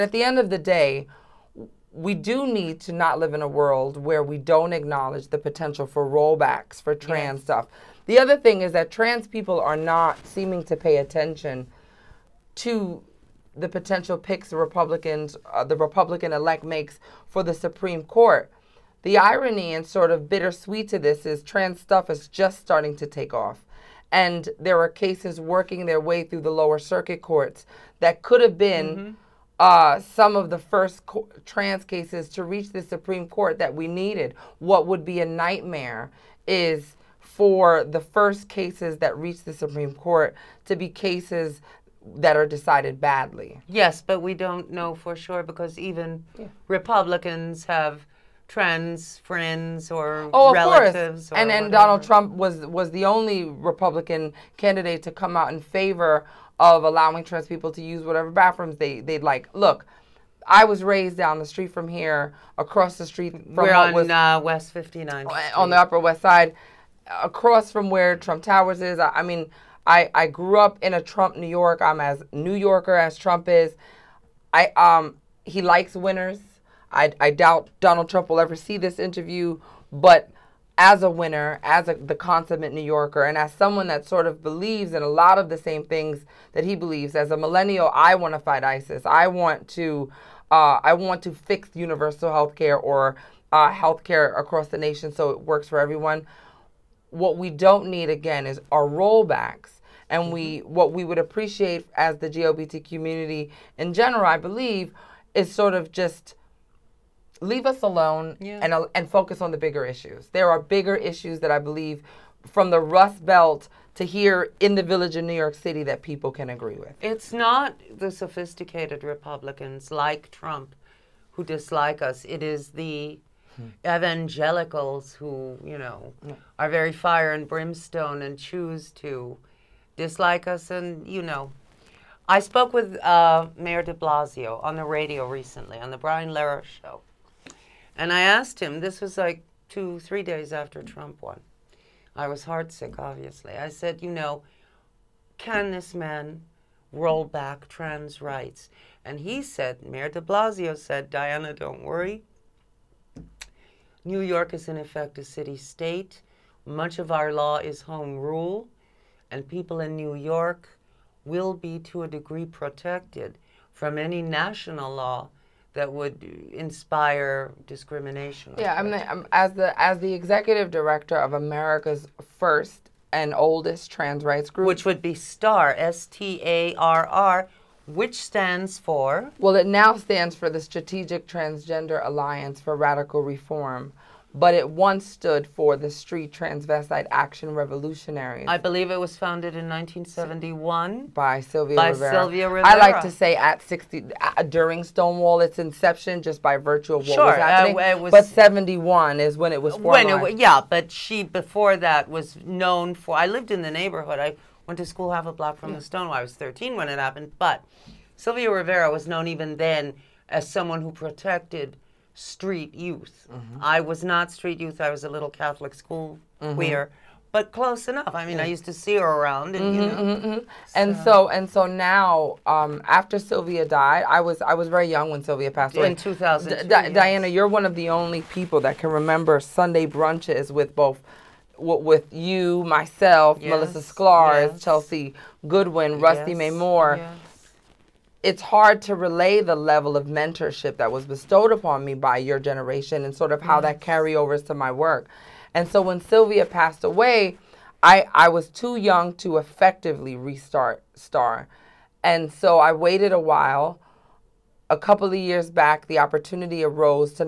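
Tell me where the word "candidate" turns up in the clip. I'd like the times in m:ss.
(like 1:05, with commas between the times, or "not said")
0:54.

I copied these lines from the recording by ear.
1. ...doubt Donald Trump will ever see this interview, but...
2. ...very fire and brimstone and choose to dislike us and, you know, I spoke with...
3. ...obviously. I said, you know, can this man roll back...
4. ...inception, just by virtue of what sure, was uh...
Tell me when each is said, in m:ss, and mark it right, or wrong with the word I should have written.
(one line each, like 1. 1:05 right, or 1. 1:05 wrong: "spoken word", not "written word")
1. 1:17 right
2. 2:06 right
3. 2:22 right
4. 3:15 right.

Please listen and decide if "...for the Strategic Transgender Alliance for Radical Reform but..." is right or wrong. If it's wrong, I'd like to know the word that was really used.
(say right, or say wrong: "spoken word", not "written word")
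right.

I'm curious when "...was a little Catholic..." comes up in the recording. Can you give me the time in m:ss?
3:34.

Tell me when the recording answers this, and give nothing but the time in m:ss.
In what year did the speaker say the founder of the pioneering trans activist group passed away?
3:45.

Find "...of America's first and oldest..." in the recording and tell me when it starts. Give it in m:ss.
2:51.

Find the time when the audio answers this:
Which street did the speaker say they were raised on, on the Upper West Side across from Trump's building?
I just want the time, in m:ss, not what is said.
1:04.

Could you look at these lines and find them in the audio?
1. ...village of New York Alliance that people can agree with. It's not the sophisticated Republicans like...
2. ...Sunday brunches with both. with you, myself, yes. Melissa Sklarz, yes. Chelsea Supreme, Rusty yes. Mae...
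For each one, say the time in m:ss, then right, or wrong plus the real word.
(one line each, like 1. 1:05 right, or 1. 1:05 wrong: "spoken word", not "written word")
1. 1:54 wrong: "City", not "Alliance"
2. 3:49 wrong: "Goodwin", not "Supreme".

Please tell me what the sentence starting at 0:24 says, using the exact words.
And there are cases working their way through the lower circuit courts that could have been mm-hmm.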